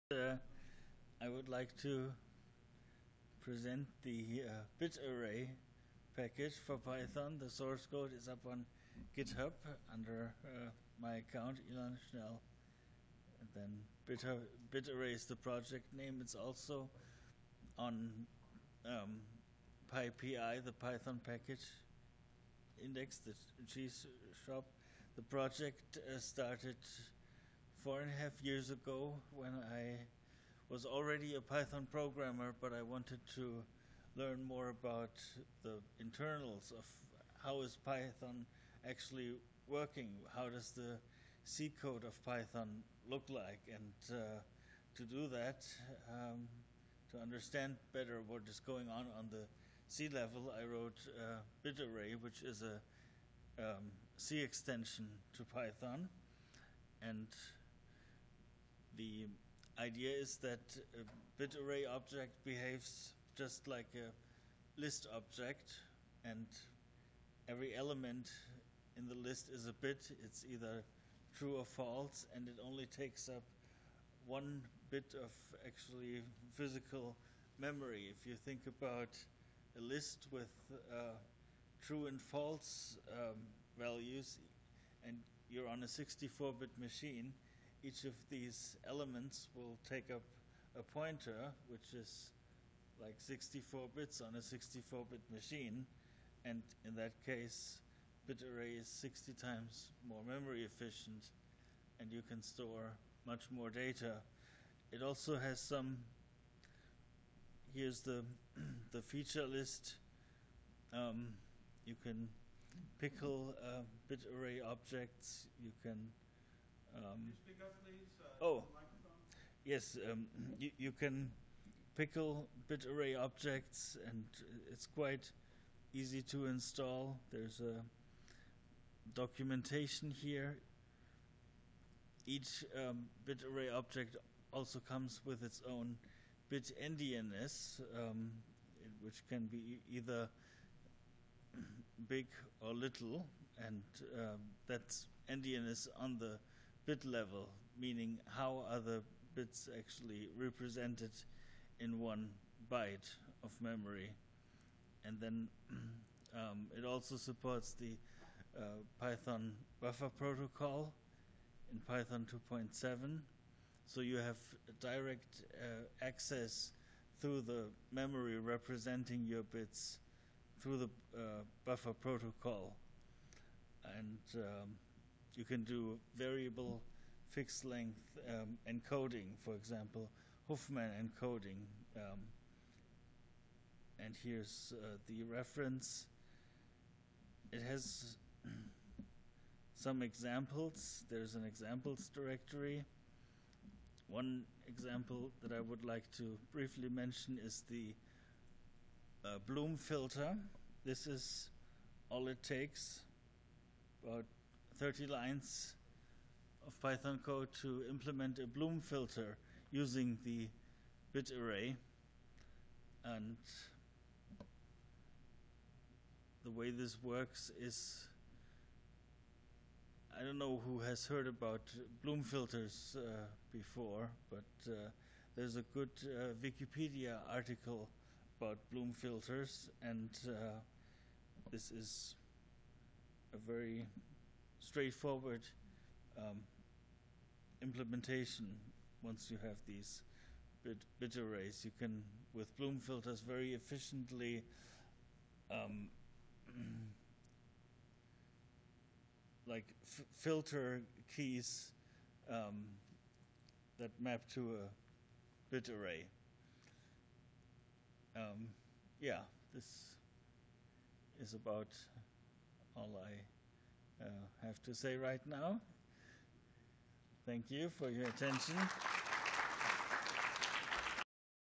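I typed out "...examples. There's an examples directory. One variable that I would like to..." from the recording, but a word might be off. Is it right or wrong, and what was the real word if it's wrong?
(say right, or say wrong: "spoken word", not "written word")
wrong: "example", not "variable".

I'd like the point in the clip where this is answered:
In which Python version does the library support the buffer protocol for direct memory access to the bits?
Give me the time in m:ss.
2:41.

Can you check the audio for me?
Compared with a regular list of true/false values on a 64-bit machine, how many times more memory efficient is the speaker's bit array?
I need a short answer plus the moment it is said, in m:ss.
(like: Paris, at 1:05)
60 times, at 1:38.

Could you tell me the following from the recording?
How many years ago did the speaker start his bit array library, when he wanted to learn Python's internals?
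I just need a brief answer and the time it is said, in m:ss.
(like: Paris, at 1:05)
4.5 years, at 0:27.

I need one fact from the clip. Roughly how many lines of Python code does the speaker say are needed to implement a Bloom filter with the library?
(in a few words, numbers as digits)
about 30.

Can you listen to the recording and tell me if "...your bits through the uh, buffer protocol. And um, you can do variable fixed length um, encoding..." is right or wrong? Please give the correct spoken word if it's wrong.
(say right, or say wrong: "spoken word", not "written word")
right.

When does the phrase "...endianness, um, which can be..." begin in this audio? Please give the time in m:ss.
2:16.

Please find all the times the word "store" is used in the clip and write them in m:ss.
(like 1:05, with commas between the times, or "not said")
1:42.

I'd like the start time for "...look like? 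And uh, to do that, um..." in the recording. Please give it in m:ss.
0:43.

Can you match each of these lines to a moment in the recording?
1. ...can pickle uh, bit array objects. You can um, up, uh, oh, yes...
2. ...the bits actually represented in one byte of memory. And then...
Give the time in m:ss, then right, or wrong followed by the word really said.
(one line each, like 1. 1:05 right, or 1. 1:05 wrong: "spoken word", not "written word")
1. 1:52 right
2. 2:28 right.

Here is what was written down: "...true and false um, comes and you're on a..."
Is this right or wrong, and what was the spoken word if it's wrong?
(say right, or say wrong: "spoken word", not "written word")
wrong: "values", not "comes".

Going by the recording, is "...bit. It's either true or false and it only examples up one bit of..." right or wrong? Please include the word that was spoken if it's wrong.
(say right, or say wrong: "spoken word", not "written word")
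wrong: "takes", not "examples".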